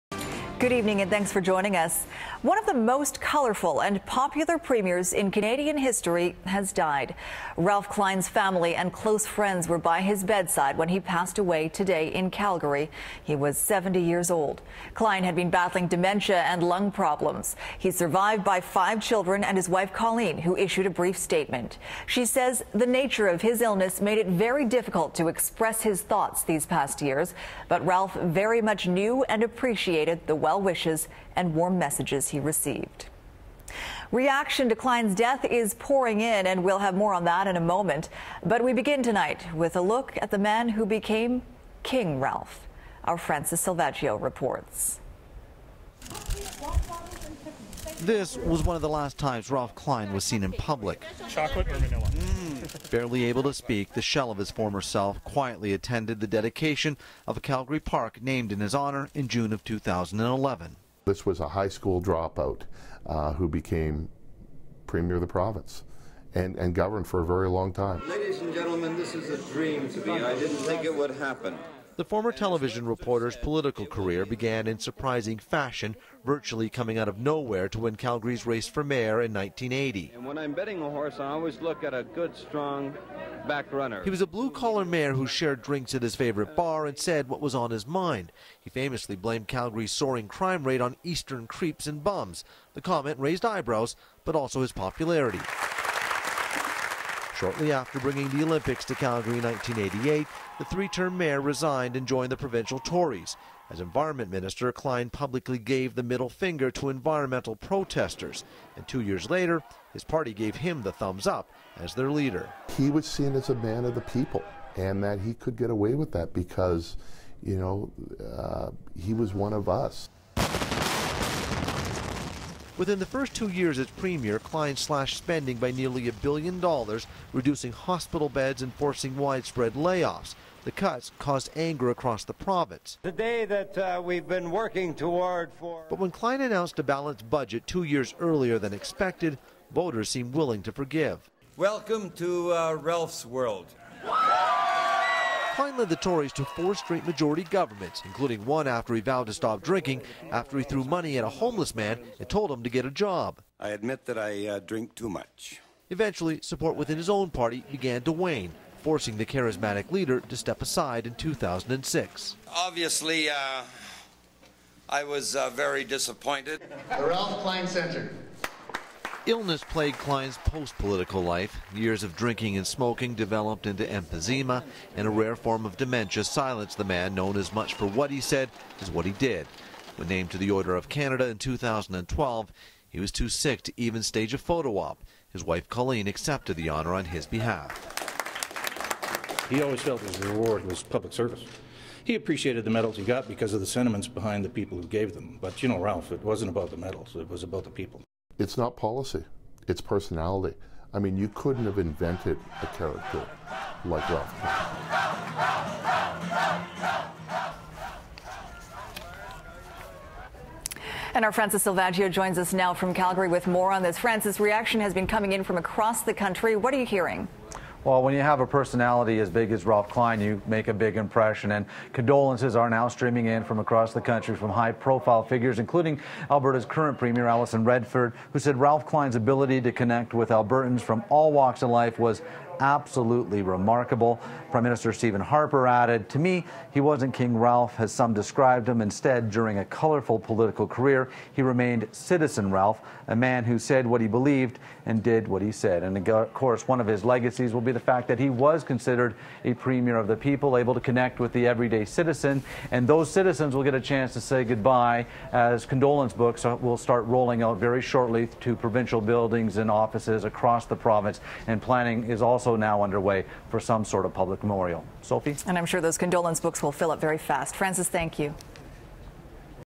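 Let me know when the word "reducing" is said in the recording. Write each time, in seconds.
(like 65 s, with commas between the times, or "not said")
127 s.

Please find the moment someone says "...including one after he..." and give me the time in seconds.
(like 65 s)
148 s.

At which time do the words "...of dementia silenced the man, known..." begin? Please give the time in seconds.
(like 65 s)
175 s.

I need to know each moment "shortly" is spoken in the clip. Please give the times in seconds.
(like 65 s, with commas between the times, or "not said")
97 s, 257 s.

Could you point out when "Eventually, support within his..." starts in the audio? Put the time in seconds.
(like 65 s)
155 s.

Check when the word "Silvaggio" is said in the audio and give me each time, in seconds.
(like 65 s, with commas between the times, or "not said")
43 s, 211 s.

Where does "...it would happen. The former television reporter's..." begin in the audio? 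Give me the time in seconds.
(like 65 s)
70 s.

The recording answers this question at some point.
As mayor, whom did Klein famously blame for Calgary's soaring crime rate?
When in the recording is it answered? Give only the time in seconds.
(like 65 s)
91 s.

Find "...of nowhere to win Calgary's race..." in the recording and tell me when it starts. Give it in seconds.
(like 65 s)
77 s.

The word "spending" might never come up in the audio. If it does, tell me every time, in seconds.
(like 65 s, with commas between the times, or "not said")
125 s.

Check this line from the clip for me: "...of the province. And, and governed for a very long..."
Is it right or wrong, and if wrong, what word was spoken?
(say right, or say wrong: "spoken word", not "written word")
right.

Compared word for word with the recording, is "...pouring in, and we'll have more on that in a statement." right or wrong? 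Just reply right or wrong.
wrong.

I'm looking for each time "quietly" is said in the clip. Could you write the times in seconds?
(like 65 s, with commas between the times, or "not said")
55 s.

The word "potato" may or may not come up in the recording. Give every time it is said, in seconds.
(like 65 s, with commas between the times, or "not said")
not said.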